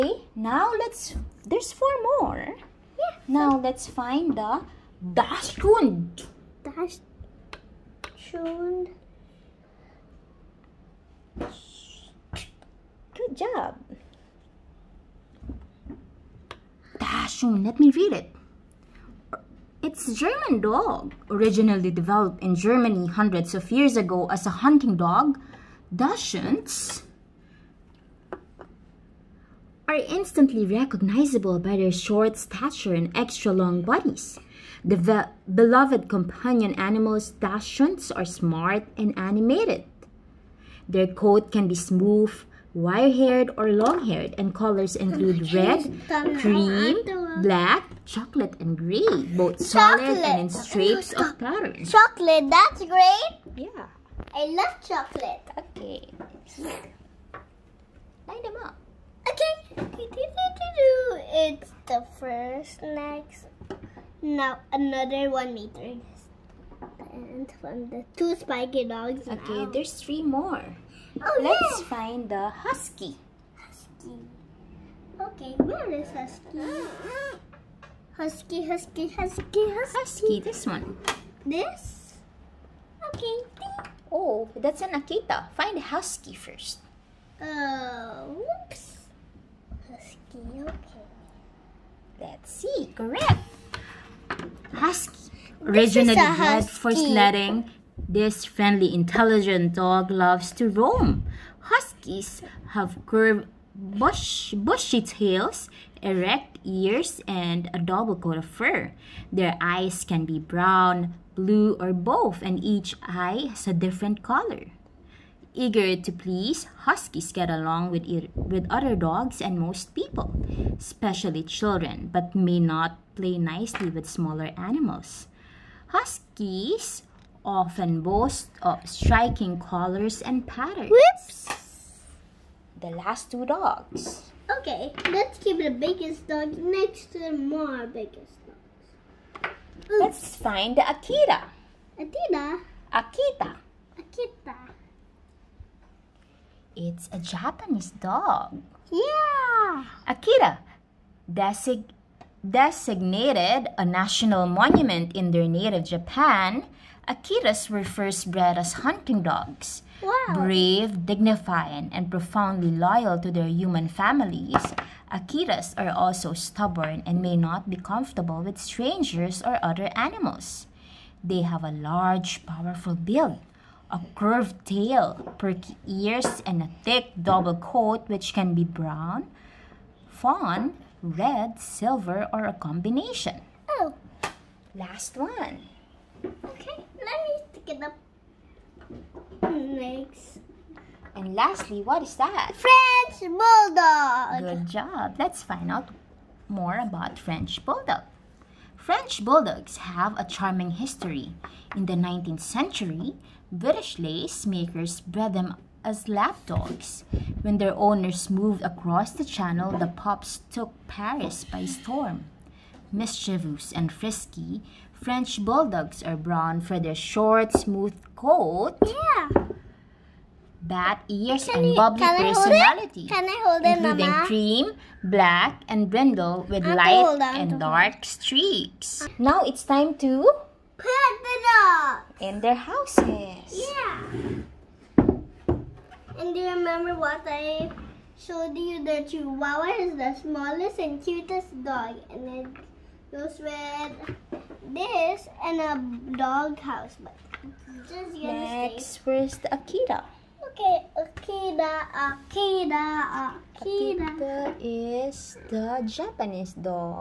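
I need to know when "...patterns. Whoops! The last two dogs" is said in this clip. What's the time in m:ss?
2:10.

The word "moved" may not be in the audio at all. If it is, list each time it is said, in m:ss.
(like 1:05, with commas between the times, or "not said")
3:28.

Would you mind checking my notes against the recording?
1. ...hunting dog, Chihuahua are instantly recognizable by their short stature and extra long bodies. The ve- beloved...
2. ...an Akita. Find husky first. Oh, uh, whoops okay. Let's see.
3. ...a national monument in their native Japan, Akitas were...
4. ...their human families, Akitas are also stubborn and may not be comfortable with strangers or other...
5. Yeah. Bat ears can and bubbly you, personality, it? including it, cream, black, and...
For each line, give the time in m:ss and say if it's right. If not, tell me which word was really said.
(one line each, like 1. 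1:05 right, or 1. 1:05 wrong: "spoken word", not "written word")
1. 0:24 wrong: "Dachshunds", not "Chihuahua"
2. 1:24 right
3. 2:33 right
4. 2:43 right
5. 3:38 right.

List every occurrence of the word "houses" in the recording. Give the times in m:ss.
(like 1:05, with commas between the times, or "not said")
3:52, 4:06.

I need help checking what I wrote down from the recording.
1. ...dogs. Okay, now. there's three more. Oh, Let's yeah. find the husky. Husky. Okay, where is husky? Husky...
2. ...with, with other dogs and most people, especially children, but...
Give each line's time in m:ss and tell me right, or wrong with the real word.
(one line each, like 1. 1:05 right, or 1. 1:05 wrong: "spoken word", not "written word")
1. 1:08 right
2. 1:57 right.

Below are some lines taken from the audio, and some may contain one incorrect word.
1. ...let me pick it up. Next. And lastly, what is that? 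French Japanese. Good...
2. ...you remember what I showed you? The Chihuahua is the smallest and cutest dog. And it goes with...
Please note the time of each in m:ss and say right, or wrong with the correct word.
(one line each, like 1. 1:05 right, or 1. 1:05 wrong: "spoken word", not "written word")
1. 3:06 wrong: "Bulldog", not "Japanese"
2. 3:56 right.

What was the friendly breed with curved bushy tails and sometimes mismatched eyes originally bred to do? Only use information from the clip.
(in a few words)
Sledding.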